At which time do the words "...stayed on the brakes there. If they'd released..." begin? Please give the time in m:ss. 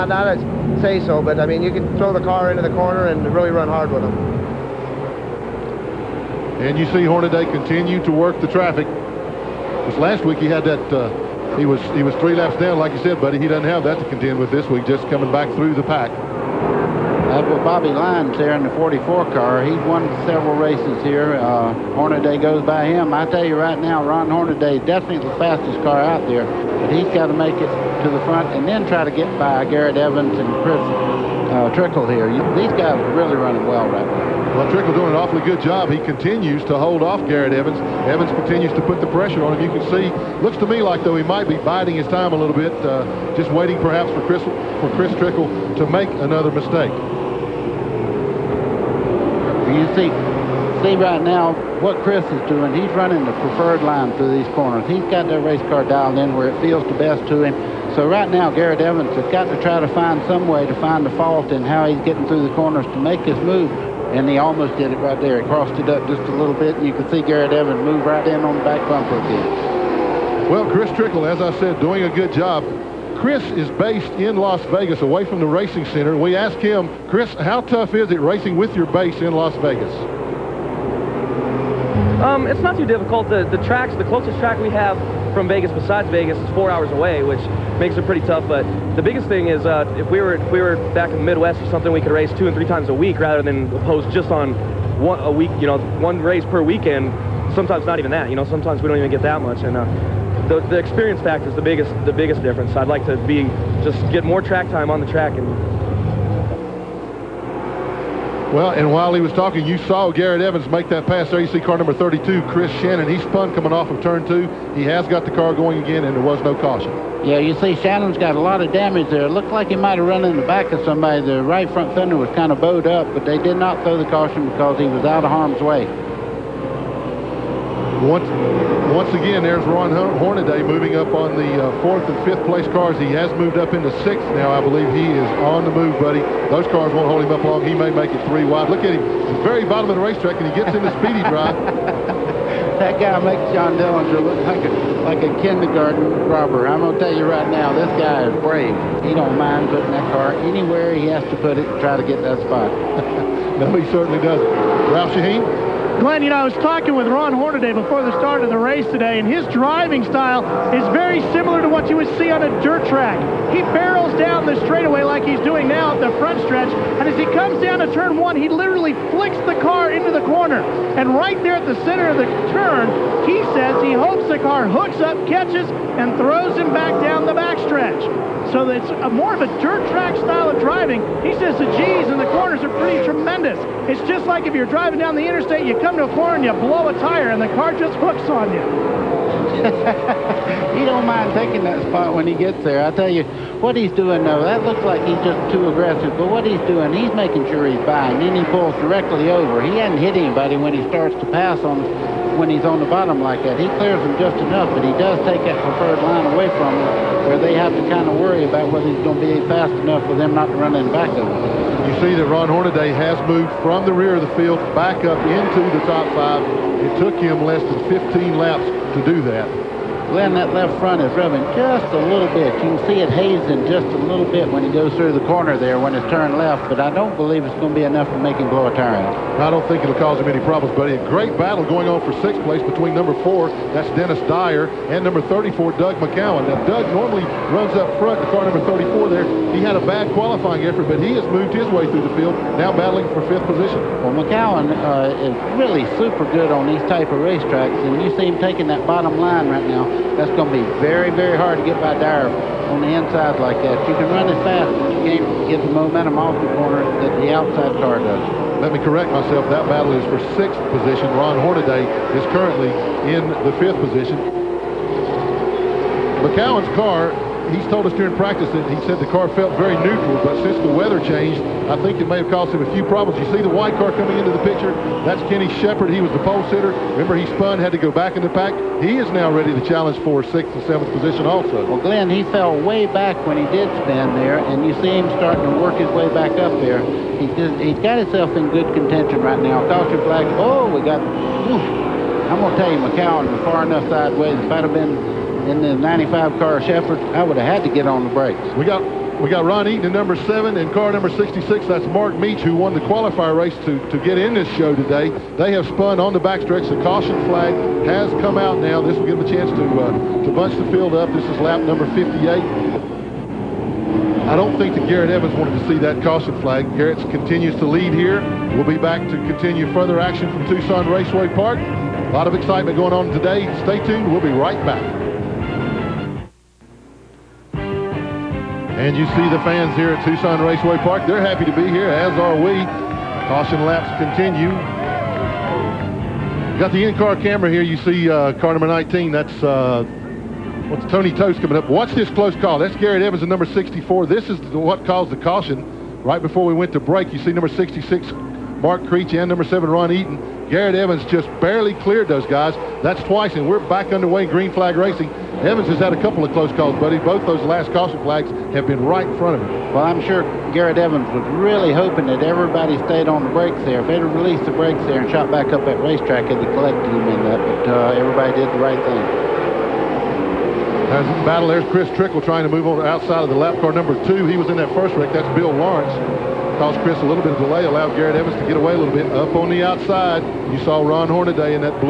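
6:02.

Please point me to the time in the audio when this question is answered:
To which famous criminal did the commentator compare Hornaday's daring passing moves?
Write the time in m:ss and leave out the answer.
2:23.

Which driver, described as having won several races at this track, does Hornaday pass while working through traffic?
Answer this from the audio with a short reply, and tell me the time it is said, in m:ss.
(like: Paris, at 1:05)
Bobby Lyons, at 0:17.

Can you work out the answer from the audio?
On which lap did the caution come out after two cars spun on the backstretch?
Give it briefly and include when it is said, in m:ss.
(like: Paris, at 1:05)
58, at 5:11.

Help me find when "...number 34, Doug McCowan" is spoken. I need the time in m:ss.
3:55.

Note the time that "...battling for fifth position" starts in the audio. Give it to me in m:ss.
4:02.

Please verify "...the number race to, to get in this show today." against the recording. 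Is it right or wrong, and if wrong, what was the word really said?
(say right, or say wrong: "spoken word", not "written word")
wrong: "qualifier", not "number".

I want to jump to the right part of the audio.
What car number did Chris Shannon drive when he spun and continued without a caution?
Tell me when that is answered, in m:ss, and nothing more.
1:51.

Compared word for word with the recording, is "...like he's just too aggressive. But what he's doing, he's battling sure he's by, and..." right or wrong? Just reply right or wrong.
wrong.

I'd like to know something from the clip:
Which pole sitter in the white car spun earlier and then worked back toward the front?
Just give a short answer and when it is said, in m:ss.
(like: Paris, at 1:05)
Kenny Shepard, at 4:35.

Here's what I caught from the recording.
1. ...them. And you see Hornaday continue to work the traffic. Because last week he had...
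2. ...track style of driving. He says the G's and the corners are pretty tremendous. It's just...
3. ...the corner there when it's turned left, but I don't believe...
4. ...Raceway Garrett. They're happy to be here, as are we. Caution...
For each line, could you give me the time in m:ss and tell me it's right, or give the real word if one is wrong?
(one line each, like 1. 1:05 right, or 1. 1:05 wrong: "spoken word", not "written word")
1. 0:04 right
2. 2:59 right
3. 3:45 right
4. 5:30 wrong: "Park", not "Garrett".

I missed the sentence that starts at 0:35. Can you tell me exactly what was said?
He continues to hold off Garrett Evans.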